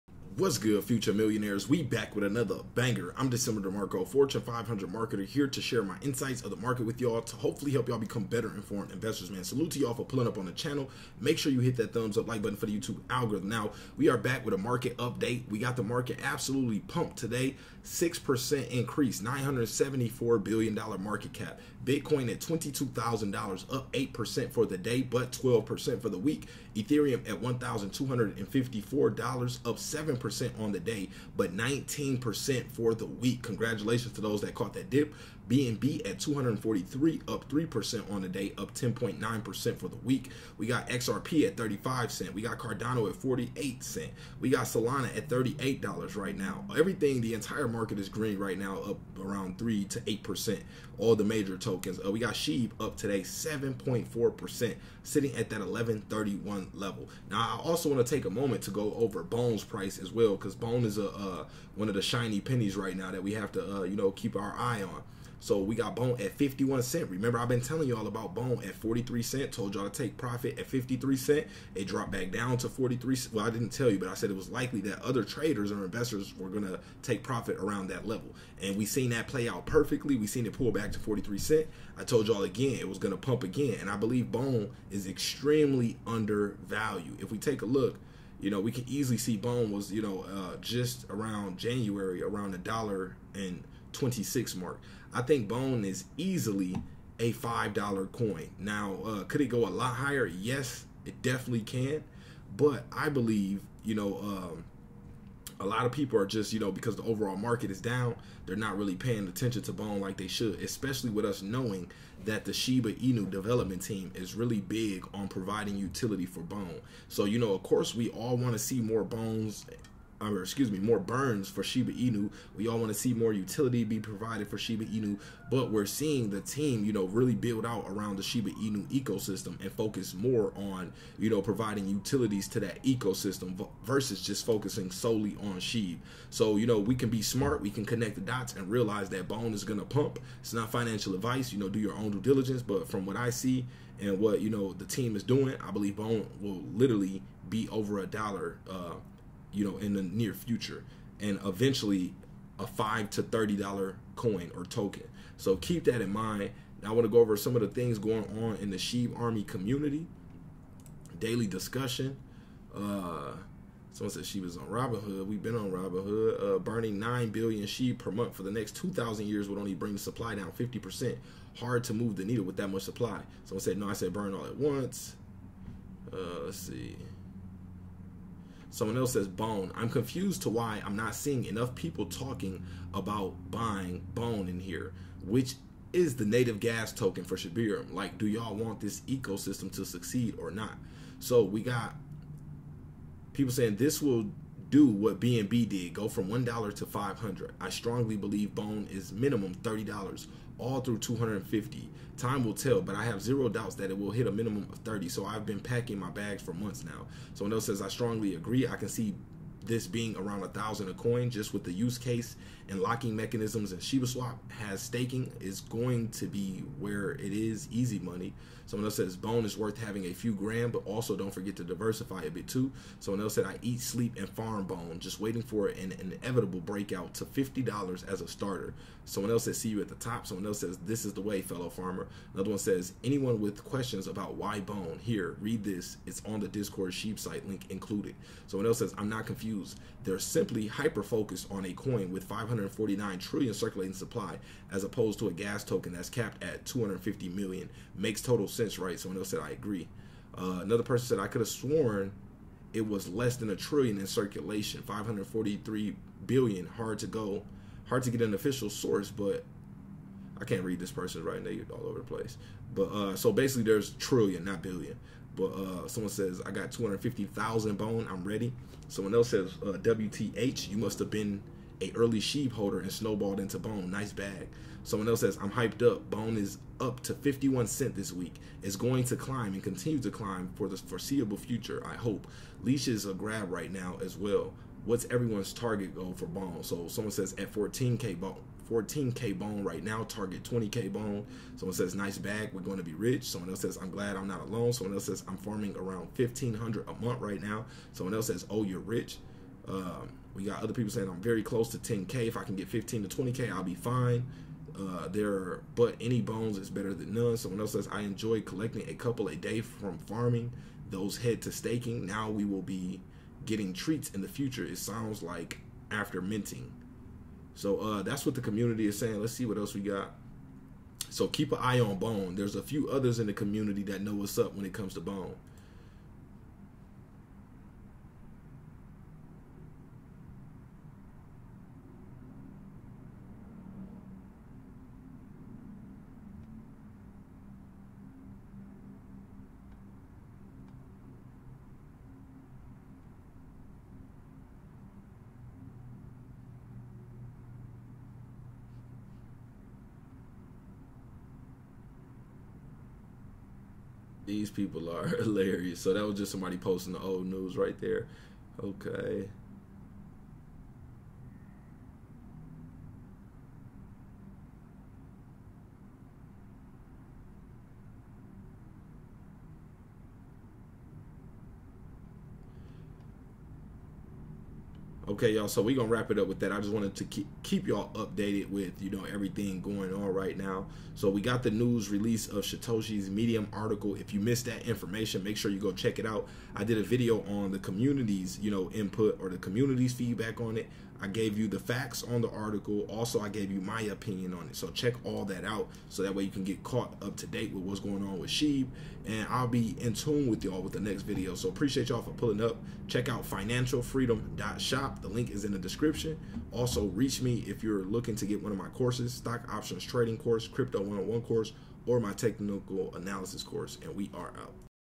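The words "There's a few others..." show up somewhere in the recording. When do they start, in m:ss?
5:22.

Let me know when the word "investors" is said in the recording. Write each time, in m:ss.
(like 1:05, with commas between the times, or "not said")
0:08, 1:15.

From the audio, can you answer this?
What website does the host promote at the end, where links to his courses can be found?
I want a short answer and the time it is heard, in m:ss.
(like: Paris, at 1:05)
financialfreedom.shop, at 6:43.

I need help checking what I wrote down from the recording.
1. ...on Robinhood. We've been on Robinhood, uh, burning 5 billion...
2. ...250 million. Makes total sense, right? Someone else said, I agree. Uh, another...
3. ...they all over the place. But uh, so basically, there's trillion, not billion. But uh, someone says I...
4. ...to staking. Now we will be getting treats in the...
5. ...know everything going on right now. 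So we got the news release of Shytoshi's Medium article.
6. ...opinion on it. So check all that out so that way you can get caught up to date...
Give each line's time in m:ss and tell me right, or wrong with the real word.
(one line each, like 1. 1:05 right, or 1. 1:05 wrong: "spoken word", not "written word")
1. 2:44 wrong: "9", not "5"
2. 4:06 right
3. 4:21 right
4. 5:11 right
5. 6:18 right
6. 6:33 right.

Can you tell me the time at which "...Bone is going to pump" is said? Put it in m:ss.
2:19.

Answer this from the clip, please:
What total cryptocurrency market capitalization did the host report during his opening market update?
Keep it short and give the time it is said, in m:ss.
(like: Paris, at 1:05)
$974 billion, at 0:19.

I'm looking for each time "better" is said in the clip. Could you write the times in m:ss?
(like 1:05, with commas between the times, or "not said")
0:08, 5:06.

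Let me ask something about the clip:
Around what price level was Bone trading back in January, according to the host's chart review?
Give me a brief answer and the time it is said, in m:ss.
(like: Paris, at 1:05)
$1.26, at 1:32.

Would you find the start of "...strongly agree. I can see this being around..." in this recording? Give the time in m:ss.
3:27.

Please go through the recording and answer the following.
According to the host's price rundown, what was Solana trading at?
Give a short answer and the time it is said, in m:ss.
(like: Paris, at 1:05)
$38, at 0:45.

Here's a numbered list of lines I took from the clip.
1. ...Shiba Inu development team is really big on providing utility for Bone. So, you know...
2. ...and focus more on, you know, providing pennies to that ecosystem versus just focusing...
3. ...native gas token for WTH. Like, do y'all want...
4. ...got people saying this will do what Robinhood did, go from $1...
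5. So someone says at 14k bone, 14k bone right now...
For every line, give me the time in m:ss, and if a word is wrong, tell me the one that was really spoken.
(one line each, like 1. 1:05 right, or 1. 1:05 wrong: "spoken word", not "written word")
1. 1:52 right
2. 2:09 wrong: "utilities", not "pennies"
3. 3:06 wrong: "Shibarium", not "WTH"
4. 3:11 wrong: "BNB", not "Robinhood"
5. 4:46 right.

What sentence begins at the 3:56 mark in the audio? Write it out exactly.
It's on the Discord sheep site link included.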